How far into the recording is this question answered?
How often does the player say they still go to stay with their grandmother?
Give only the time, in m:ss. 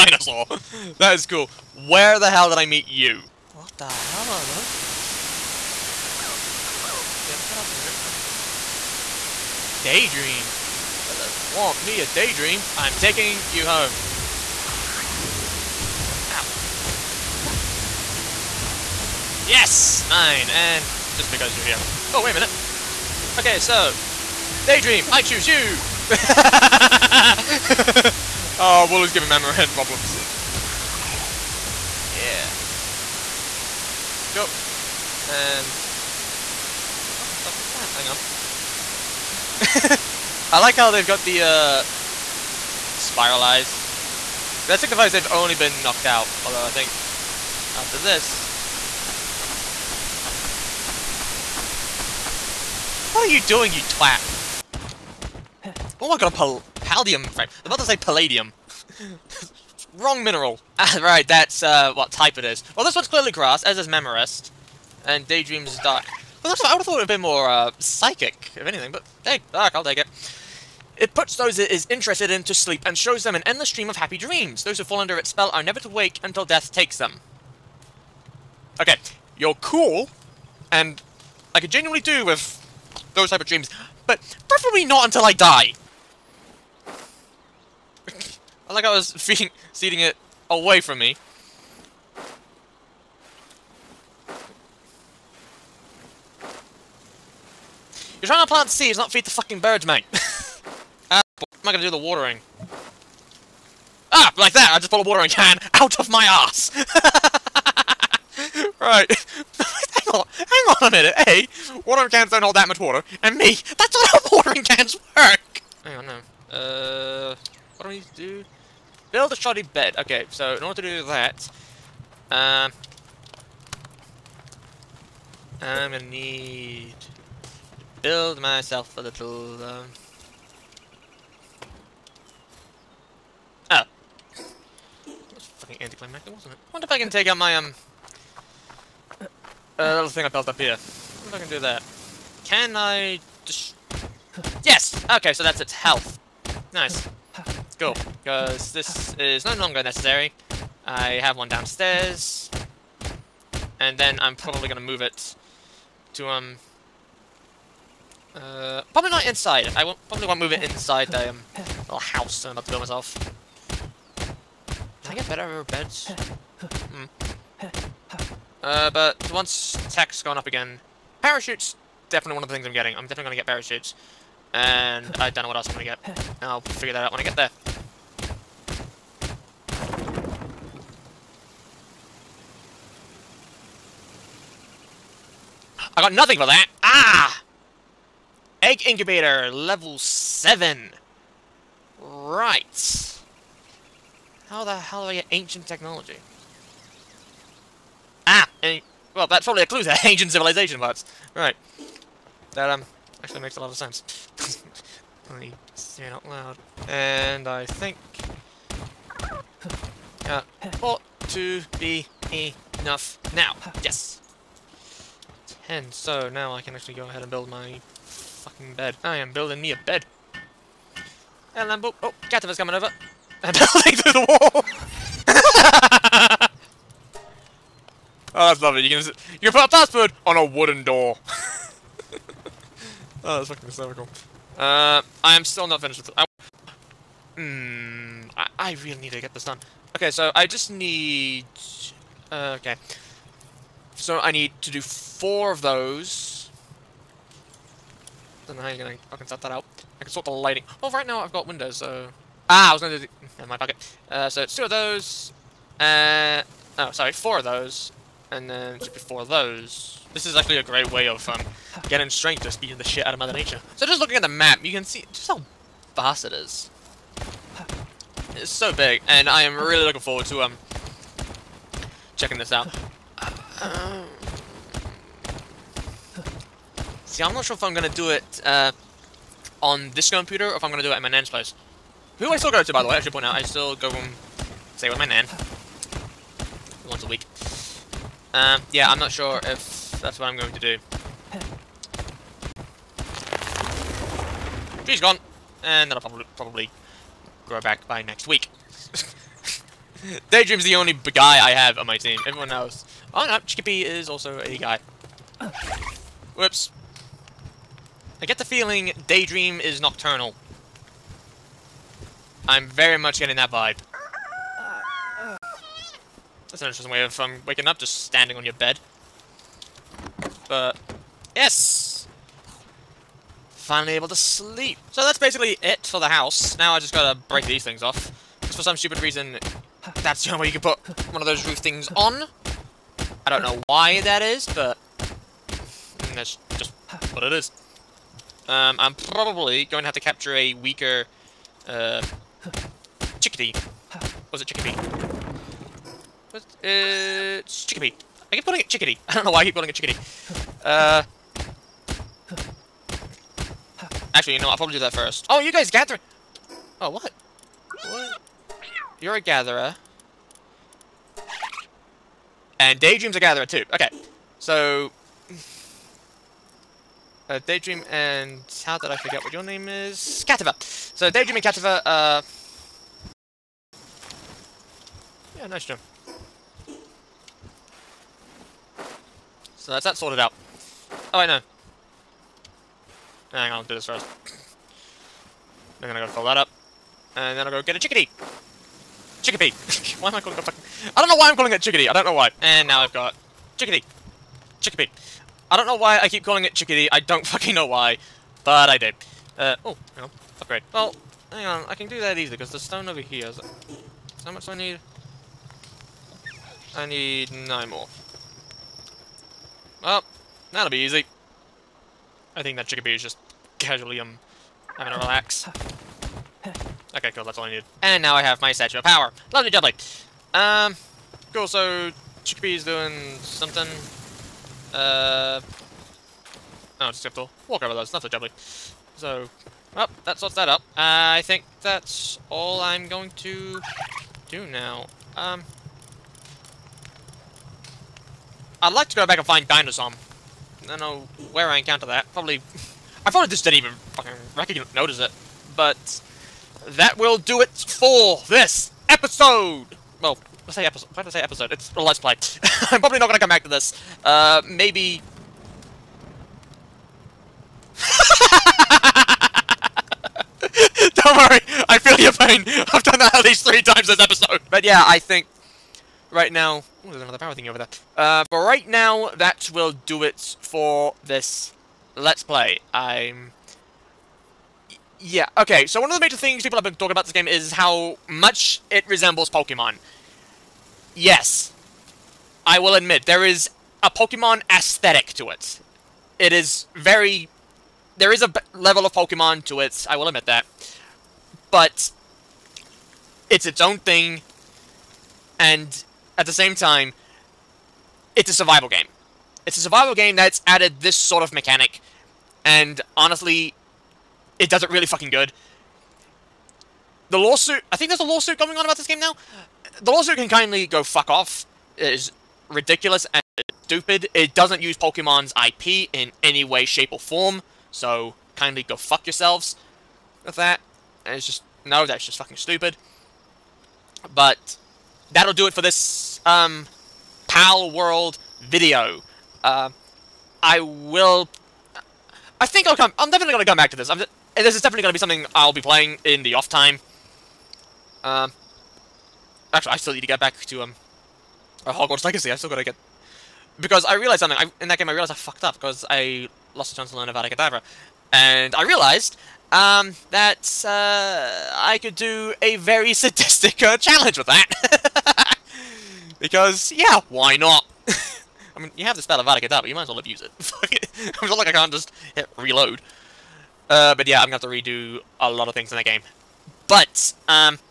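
4:46.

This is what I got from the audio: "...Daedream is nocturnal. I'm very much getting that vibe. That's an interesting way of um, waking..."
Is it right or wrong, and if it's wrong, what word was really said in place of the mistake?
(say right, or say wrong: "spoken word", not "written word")
right.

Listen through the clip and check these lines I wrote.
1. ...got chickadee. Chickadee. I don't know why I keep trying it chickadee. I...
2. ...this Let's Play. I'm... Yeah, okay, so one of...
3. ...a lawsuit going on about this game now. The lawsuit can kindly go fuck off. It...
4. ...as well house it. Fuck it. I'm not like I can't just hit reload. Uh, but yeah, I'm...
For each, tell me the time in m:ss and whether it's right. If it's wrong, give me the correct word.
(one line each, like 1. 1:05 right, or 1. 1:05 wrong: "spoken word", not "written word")
1. 6:32 wrong: "calling", not "trying"
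2. 7:51 right
3. 8:27 right
4. 9:19 wrong: "abuse", not "house".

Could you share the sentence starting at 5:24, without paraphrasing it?
So that's basically it for the house.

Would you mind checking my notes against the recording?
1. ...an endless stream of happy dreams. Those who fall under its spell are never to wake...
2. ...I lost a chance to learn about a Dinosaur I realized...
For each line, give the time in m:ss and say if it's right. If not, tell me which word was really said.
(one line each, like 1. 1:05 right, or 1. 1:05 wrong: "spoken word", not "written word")
1. 1:13 right
2. 9:05 wrong: "And", not "Dinosaur".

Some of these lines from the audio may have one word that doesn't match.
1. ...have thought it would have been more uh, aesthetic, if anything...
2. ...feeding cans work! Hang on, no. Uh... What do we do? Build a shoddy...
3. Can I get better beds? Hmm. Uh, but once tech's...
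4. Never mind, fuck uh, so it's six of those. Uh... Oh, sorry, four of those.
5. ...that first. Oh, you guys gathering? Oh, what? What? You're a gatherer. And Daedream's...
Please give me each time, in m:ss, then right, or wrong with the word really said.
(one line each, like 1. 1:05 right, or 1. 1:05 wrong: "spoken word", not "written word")
1. 1:06 wrong: "psychic", not "aesthetic"
2. 1:54 wrong: "watering", not "feeding"
3. 2:44 right
4. 4:13 wrong: "two", not "six"
5. 5:54 right.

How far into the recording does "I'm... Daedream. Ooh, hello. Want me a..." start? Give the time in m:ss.
0:08.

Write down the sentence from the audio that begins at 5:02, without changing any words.
Everyone else Oh no, Chippy is also a guy.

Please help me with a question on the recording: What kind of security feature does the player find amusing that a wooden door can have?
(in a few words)
A password.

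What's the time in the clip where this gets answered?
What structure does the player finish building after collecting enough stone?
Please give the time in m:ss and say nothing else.
6:58.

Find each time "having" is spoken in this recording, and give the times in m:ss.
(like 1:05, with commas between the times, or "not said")
6:54.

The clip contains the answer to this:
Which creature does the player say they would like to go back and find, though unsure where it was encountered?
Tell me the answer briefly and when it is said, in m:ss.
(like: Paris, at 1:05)
Dinosaur, at 7:19.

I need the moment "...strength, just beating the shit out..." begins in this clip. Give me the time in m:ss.
4:22.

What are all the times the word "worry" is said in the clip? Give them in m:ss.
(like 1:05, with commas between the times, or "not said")
7:41.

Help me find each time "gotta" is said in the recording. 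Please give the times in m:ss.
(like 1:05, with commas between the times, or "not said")
5:26, 6:25.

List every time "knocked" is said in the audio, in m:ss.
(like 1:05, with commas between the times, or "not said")
0:45.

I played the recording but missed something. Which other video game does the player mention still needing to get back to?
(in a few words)
Hogwarts Legacy.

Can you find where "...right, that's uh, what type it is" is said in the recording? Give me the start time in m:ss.
1:00.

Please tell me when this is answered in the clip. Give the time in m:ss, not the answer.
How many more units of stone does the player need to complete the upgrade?
6:47.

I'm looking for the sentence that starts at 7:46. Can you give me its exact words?
there's another power thingy over there.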